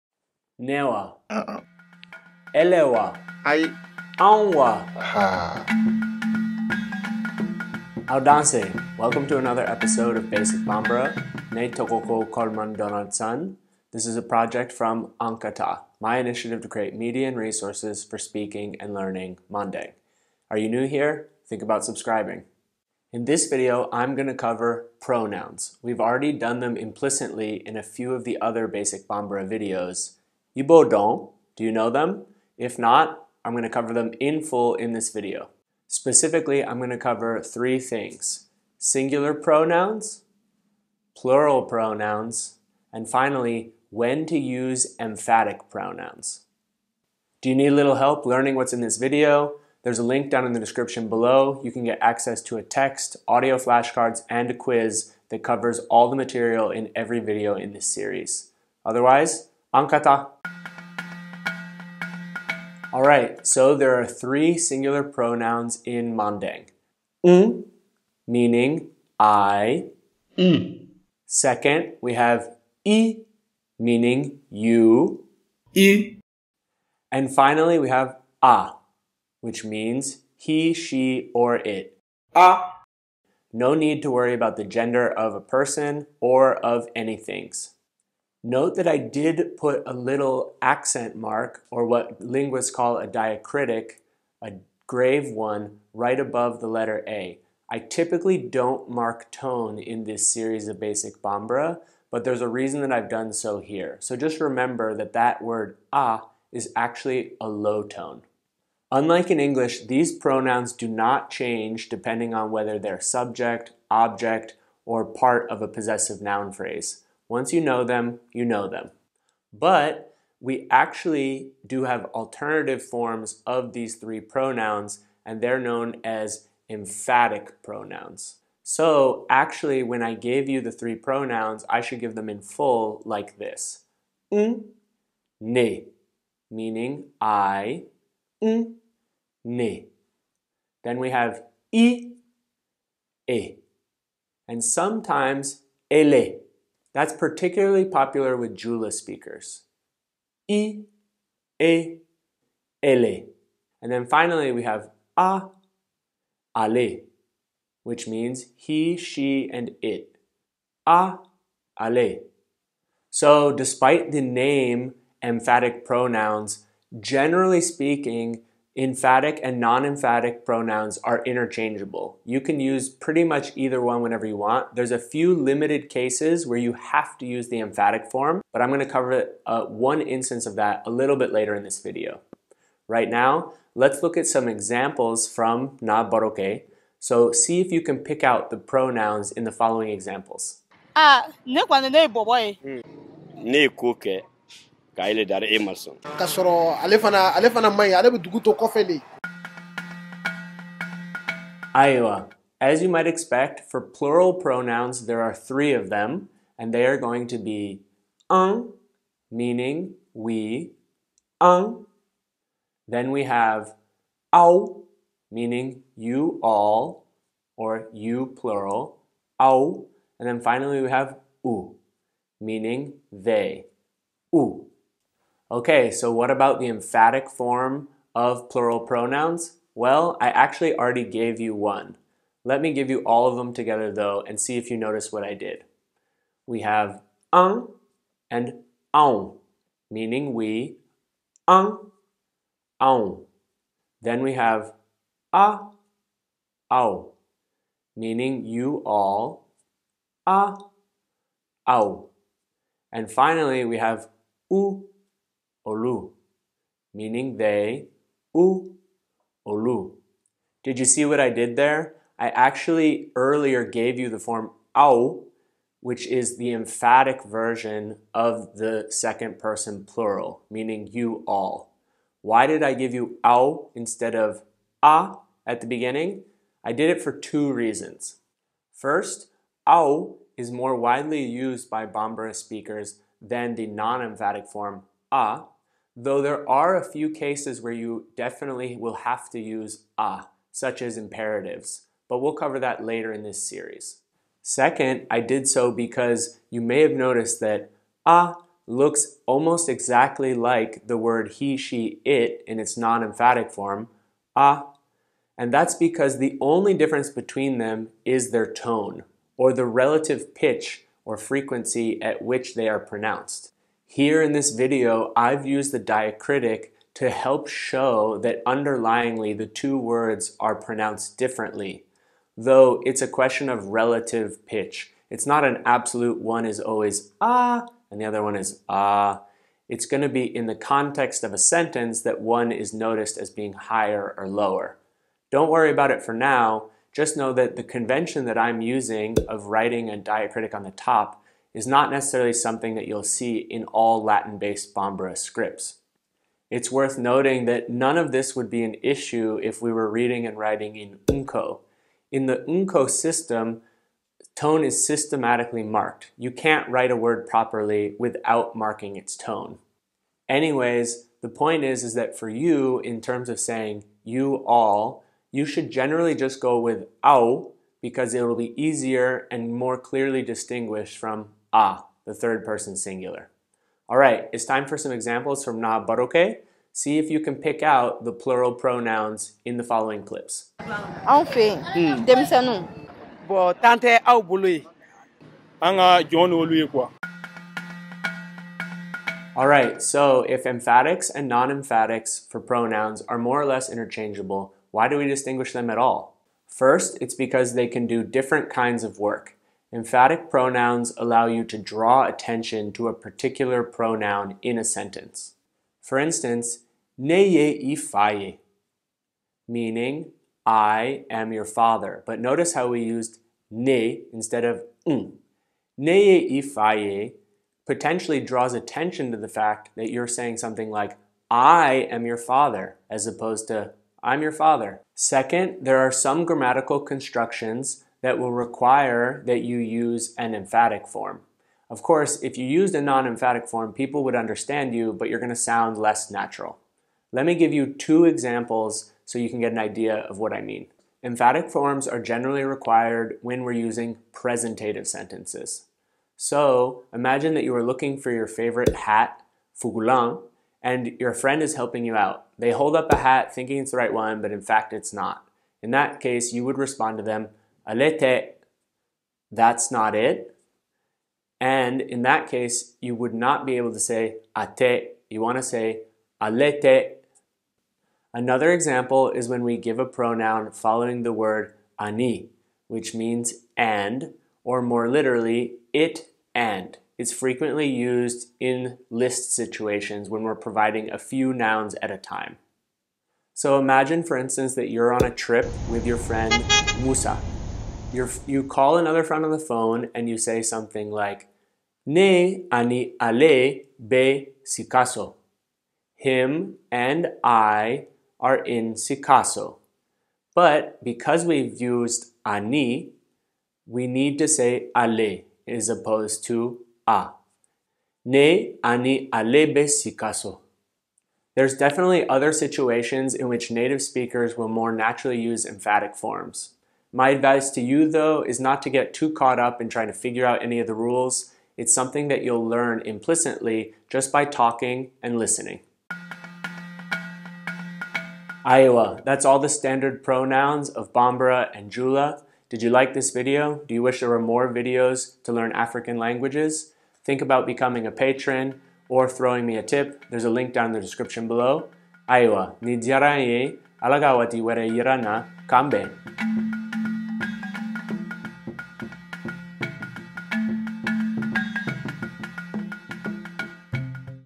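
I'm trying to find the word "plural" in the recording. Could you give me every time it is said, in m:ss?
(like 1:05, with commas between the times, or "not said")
0:41, 3:23, 3:38, 3:48, 4:29, 6:18.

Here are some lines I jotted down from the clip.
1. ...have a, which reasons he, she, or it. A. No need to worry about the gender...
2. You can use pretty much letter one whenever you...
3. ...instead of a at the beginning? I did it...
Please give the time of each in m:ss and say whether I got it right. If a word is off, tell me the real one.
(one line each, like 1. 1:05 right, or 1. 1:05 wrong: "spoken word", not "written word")
1. 1:17 wrong: "means", not "reasons"
2. 2:52 wrong: "either", not "letter"
3. 4:33 right.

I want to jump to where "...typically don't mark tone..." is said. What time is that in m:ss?
1:37.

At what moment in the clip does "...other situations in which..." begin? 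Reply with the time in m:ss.
8:32.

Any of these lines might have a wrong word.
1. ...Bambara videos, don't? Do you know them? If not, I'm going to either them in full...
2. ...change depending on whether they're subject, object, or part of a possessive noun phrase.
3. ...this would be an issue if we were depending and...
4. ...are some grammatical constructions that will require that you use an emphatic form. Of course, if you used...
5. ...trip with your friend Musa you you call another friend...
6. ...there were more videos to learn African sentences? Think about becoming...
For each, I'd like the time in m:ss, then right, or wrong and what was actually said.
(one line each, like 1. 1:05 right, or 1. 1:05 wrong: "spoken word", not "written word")
1. 0:29 wrong: "cover", not "either"
2. 1:51 right
3. 5:48 wrong: "reading", not "depending"
4. 7:05 right
5. 8:05 right
6. 8:54 wrong: "languages", not "sentences".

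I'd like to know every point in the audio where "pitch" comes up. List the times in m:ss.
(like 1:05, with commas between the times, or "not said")
5:10, 5:24.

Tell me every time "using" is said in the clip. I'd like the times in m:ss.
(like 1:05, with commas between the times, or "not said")
5:38, 7:23.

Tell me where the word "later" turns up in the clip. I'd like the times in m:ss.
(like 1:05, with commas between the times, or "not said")
3:01, 4:52.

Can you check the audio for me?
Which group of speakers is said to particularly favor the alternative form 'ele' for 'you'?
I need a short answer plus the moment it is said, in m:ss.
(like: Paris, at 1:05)
Jula speakers, at 2:28.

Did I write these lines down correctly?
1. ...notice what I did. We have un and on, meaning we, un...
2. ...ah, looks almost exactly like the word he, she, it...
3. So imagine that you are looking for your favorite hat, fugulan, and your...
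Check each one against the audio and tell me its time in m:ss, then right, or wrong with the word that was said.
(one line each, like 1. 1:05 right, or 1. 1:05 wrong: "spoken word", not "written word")
1. 3:54 right
2. 4:58 right
3. 7:26 right.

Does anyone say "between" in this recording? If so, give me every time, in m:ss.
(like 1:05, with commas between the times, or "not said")
5:07.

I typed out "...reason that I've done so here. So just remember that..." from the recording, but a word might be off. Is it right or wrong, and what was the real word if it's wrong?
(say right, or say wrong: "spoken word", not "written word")
right.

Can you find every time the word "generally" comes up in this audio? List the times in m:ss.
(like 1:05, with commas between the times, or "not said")
2:46, 6:05, 7:22.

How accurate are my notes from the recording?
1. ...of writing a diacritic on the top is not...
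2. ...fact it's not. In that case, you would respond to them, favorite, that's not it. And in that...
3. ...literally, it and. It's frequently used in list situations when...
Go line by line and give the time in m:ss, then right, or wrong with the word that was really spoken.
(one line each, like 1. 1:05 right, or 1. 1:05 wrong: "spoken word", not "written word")
1. 5:39 right
2. 7:34 wrong: "alete", not "favorite"
3. 7:54 right.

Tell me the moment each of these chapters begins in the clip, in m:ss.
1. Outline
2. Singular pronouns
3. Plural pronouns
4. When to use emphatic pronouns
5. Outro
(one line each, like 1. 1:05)
1. 0:35
2. 1:00
3. 3:19
4. 6:26
5. 8:45.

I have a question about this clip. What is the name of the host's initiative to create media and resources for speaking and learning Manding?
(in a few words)
An ka taa.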